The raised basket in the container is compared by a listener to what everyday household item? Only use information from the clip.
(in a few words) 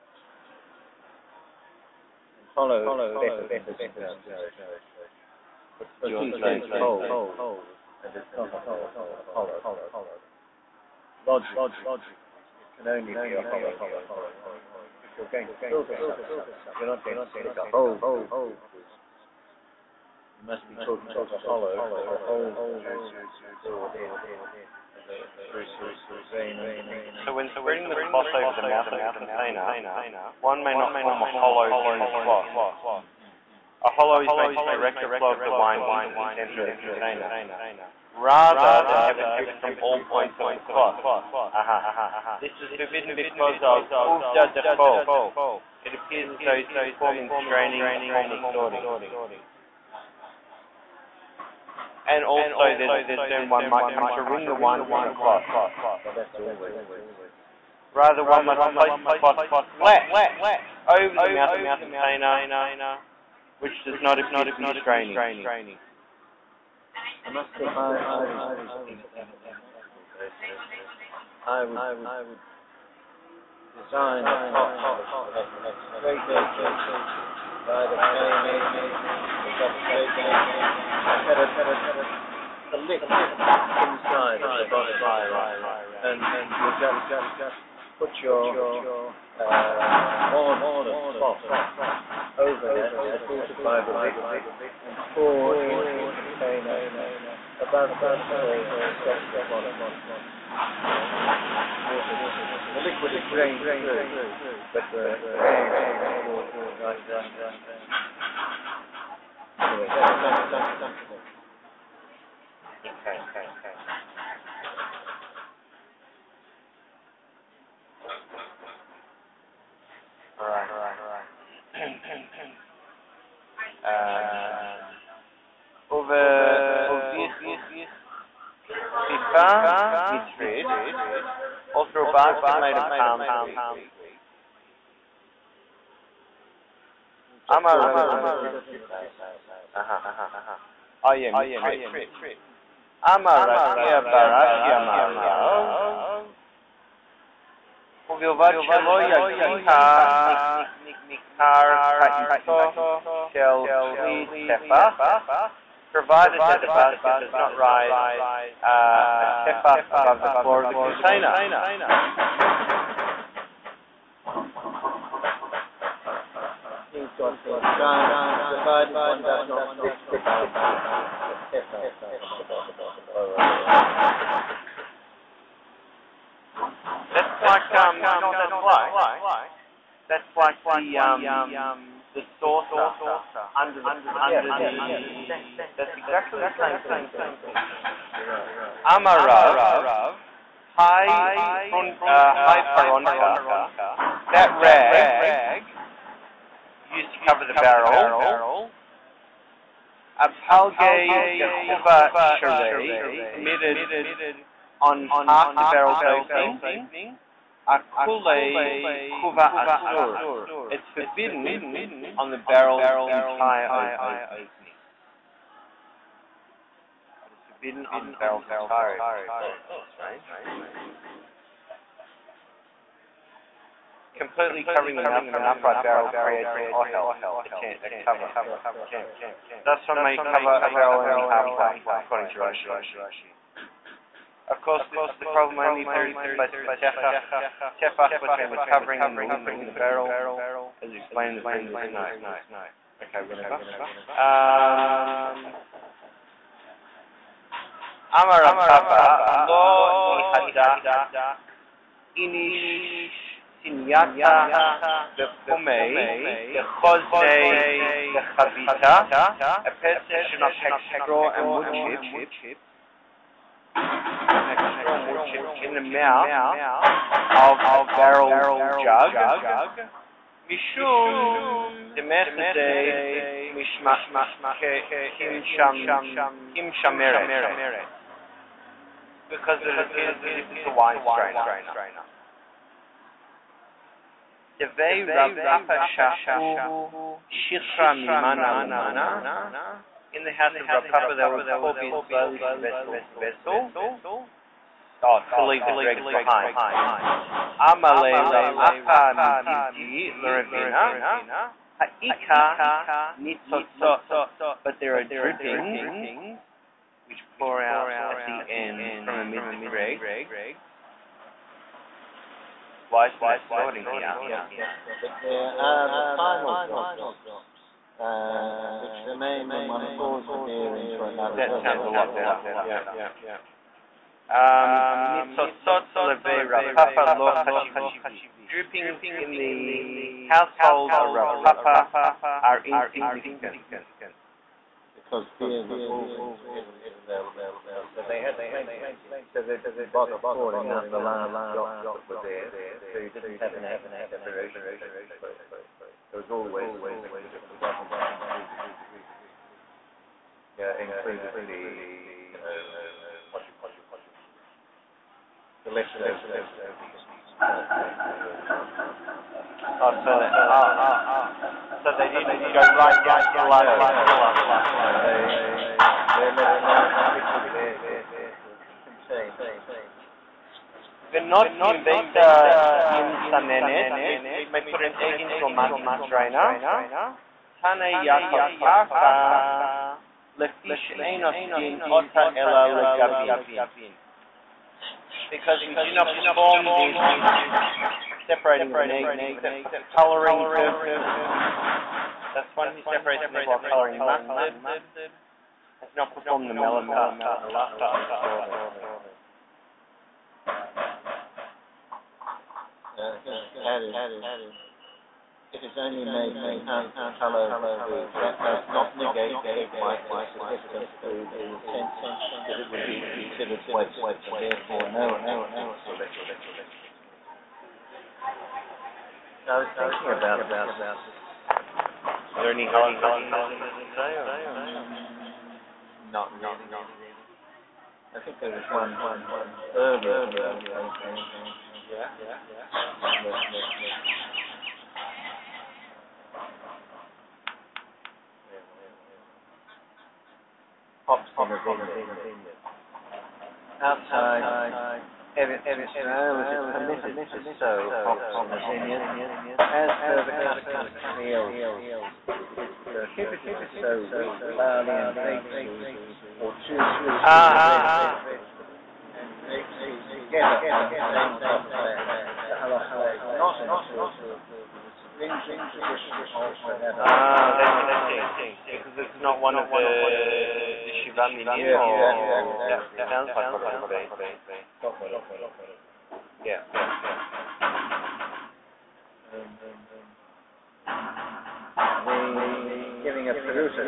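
saucer.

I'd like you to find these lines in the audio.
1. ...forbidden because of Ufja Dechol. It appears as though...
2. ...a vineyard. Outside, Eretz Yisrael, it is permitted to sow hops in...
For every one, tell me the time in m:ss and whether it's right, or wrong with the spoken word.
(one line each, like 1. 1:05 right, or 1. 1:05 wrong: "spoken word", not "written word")
1. 0:42 right
2. 7:21 right.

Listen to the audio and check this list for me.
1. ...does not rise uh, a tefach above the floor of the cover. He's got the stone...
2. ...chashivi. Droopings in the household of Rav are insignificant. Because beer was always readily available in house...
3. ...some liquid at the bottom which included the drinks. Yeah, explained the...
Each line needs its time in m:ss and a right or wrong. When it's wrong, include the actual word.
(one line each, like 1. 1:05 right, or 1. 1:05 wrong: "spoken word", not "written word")
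1. 2:37 wrong: "container", not "cover"
2. 5:27 wrong: "Papa", not "Rav"
3. 5:46 wrong: "included", not "explained".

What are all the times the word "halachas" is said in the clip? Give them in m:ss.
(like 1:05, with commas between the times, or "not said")
7:02, 7:42.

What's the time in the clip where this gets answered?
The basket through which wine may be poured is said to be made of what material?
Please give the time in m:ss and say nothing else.
2:12.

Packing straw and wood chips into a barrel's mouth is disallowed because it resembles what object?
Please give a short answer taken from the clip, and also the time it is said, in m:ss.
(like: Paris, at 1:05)
wine strainer, at 4:40.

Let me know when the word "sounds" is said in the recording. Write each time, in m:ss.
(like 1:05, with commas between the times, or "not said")
5:21, 7:53.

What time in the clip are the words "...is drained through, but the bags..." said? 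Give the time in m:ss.
1:43.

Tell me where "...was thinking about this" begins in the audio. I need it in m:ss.
6:59.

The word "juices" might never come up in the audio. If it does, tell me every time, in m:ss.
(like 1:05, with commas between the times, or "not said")
0:22.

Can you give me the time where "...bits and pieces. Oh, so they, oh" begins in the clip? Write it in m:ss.
5:56.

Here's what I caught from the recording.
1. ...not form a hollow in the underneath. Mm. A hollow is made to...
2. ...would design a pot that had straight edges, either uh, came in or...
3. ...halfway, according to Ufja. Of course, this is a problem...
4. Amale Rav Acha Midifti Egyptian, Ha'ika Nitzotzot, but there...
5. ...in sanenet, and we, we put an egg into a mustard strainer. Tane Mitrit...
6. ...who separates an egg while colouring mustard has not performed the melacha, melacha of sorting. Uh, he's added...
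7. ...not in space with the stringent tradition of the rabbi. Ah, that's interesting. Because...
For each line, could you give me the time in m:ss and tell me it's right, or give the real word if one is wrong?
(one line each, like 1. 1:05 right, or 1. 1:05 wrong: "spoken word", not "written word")
1. 0:30 wrong: "cloth", not "underneath"
2. 1:11 right
3. 3:51 wrong: "Rashi", not "Ufja"
4. 4:57 wrong: "Leravina", not "Egyptian"
5. 6:12 wrong: "Yaakov", not "Mitrit"
6. 6:32 right
7. 7:43 wrong: "accordance", not "space".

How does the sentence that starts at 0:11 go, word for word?
Logically, it can only be a hollow, not a hole.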